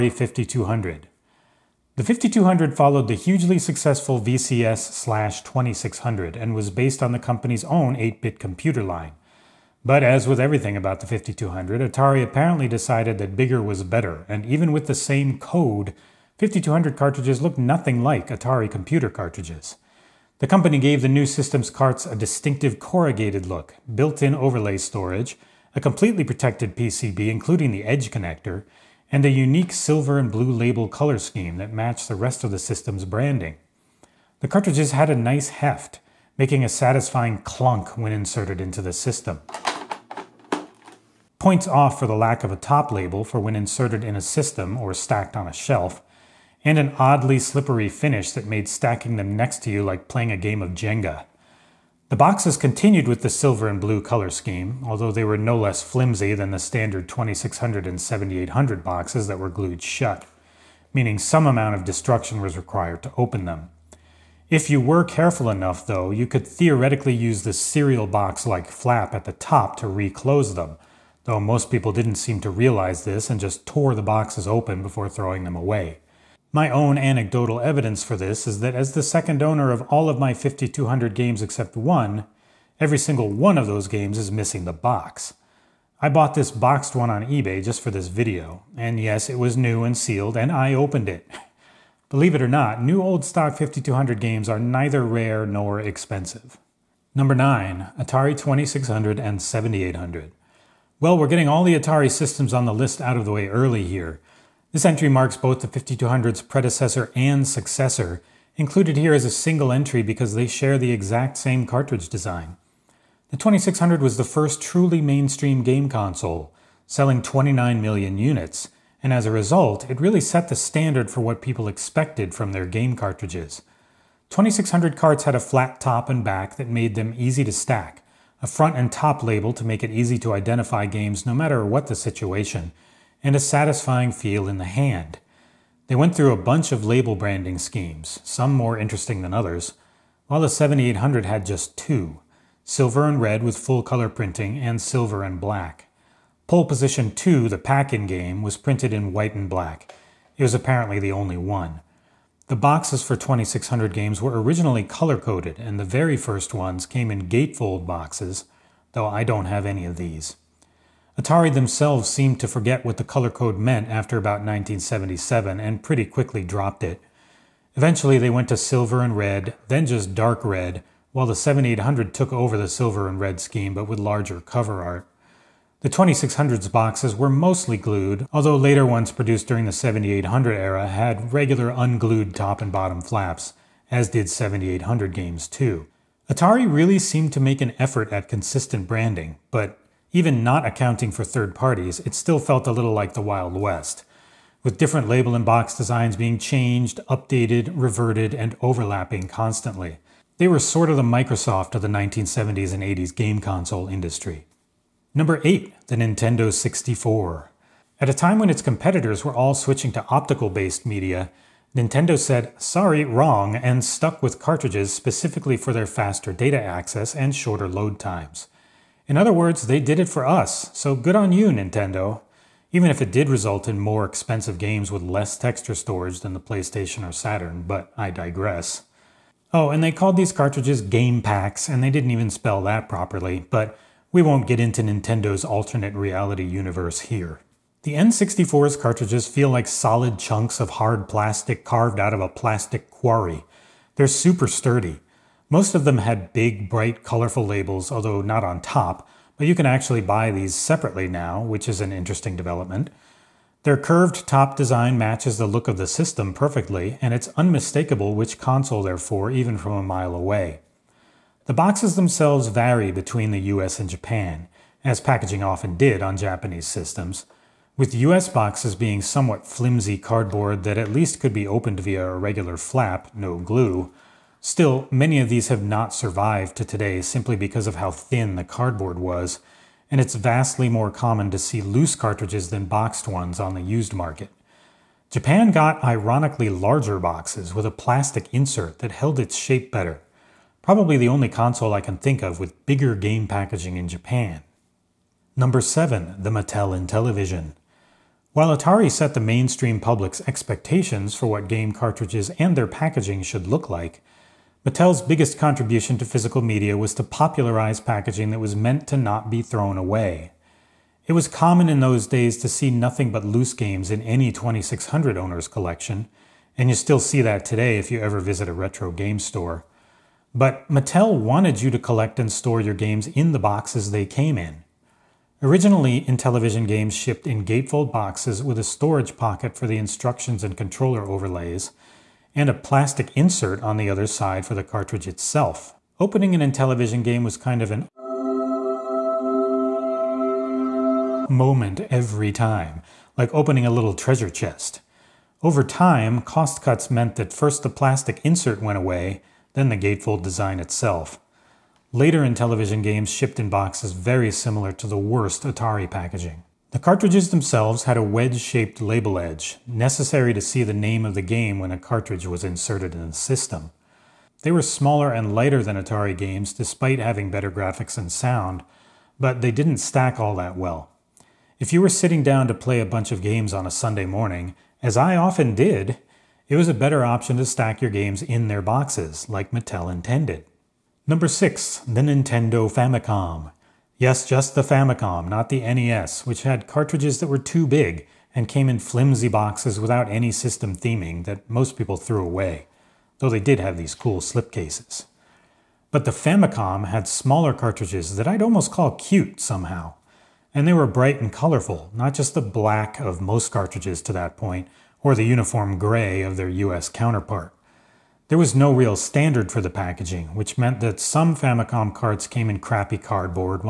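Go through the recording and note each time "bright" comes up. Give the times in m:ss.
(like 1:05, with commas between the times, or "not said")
4:06, 6:40.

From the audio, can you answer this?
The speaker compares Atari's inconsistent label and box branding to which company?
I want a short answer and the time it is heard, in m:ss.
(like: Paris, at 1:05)
Microsoft, at 3:21.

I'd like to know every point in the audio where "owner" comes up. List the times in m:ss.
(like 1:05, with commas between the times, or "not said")
1:19, 5:15.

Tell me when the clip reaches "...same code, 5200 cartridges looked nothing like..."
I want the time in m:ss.
0:14.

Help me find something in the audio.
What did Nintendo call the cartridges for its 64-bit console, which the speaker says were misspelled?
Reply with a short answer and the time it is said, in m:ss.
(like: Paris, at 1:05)
game packs, at 3:50.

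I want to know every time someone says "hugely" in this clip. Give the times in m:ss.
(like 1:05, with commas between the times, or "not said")
0:03.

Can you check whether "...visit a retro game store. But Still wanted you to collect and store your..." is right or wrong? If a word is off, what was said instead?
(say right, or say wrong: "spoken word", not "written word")
wrong: "Mattel", not "Still".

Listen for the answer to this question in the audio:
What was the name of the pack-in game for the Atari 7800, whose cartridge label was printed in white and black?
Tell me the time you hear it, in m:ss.
2:26.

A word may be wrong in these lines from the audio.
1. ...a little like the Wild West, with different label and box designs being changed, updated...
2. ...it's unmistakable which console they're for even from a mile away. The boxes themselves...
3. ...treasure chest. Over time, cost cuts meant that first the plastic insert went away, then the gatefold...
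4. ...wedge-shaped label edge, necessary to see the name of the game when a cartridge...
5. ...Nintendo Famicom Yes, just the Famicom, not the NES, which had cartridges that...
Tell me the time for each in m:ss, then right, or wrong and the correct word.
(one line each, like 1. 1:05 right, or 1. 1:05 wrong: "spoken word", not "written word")
1. 3:12 right
2. 4:17 right
3. 5:43 right
4. 5:58 right
5. 6:22 right.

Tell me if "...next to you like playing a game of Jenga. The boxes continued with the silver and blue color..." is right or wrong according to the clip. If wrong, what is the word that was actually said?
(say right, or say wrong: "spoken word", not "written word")
right.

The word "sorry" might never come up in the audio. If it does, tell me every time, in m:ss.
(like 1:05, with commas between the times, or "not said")
3:32.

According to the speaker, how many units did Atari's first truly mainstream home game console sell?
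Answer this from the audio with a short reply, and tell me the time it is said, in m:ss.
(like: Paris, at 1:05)
29 million, at 1:57.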